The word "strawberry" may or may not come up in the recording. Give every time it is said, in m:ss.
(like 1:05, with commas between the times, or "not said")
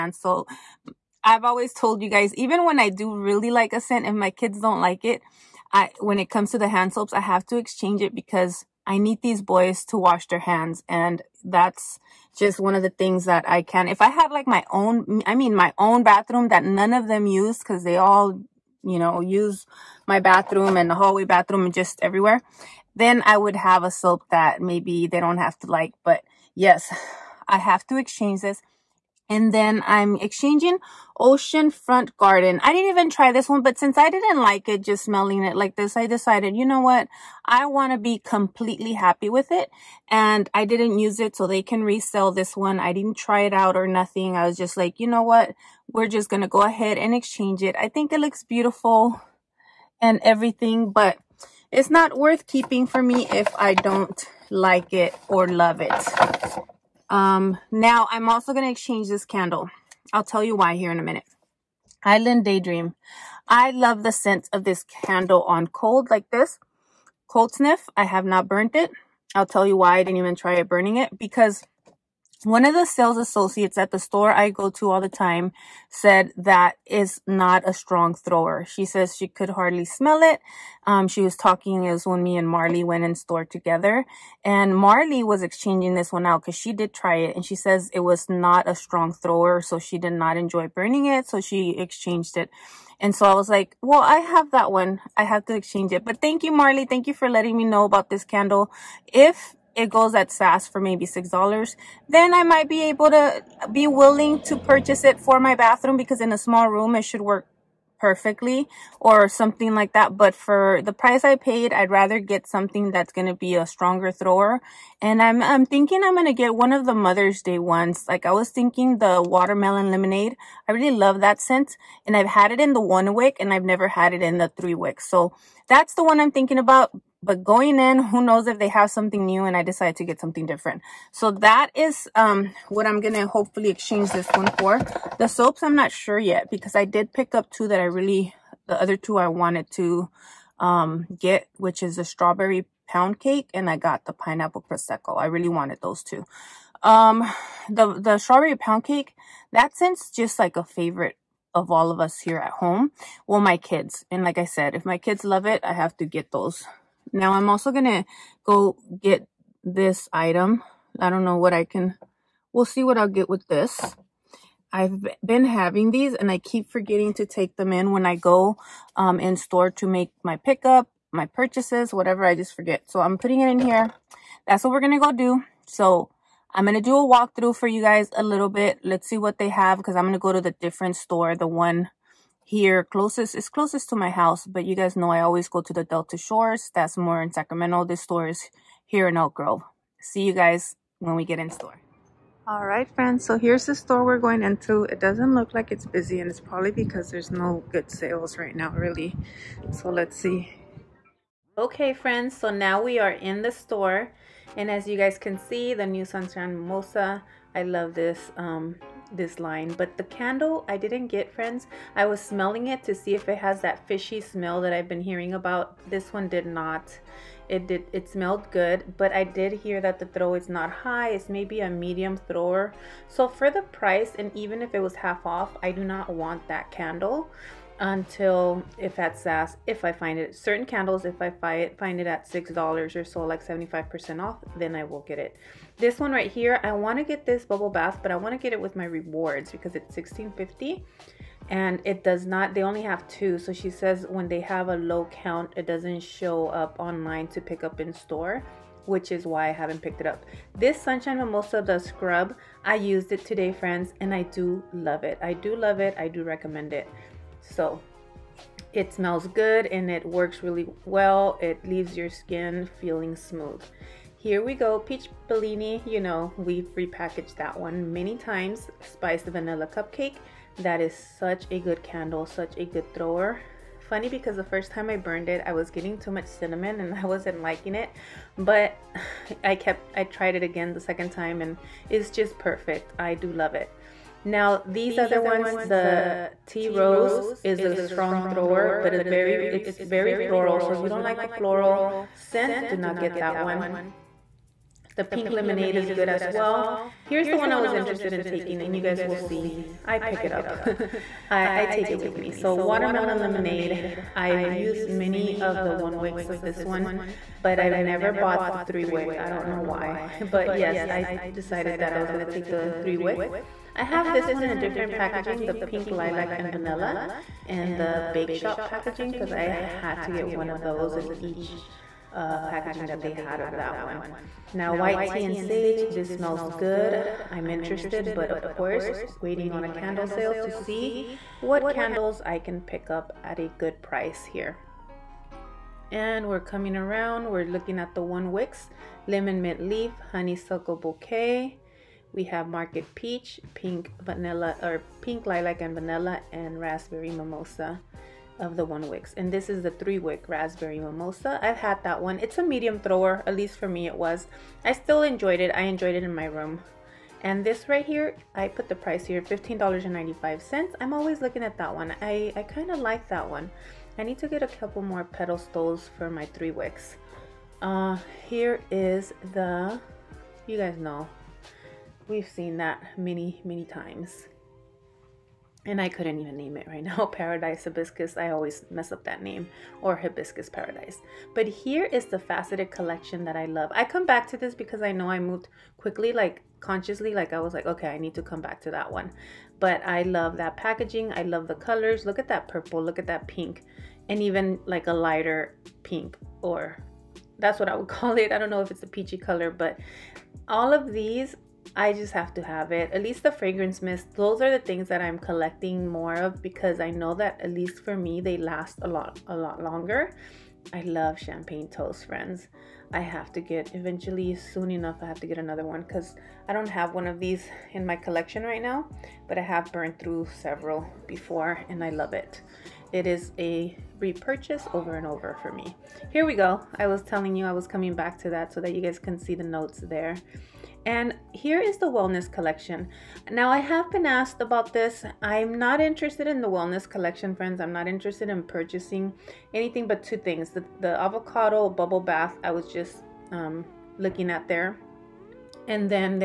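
2:22, 2:28.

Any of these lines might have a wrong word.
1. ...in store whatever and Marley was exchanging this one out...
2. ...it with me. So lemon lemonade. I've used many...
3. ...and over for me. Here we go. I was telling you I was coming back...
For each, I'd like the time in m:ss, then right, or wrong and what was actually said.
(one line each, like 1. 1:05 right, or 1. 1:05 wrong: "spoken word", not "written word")
1. 1:23 wrong: "together", not "whatever"
2. 5:01 wrong: "watermelon", not "lemon"
3. 7:04 right.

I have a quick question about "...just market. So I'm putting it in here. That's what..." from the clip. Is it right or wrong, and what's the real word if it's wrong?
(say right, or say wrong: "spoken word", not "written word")
wrong: "forget", not "market".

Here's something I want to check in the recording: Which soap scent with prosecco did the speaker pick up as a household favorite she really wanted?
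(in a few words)
Pineapple Prosecco.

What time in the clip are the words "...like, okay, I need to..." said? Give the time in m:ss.
6:27.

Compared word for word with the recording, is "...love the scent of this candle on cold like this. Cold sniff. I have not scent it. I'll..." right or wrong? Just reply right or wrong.
wrong.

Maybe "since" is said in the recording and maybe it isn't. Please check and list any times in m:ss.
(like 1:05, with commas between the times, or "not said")
0:33, 2:29.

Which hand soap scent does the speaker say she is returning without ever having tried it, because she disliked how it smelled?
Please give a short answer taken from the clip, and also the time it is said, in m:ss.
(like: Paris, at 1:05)
Ocean Front Garden, at 0:31.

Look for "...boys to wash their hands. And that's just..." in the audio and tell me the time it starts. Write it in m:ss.
0:09.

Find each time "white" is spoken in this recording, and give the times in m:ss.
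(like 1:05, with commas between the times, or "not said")
5:24.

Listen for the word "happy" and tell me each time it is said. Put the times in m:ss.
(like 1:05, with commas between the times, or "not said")
0:38.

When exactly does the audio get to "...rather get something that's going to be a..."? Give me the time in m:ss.
1:51.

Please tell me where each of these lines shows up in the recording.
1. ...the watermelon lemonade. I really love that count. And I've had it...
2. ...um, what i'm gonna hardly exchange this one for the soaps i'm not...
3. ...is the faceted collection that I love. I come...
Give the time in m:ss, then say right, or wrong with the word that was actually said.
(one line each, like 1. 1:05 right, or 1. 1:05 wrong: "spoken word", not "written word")
1. 1:58 wrong: "scent", not "count"
2. 2:12 wrong: "hopefully", not "hardly"
3. 6:21 right.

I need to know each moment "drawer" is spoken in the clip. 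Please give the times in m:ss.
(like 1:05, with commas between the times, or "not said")
not said.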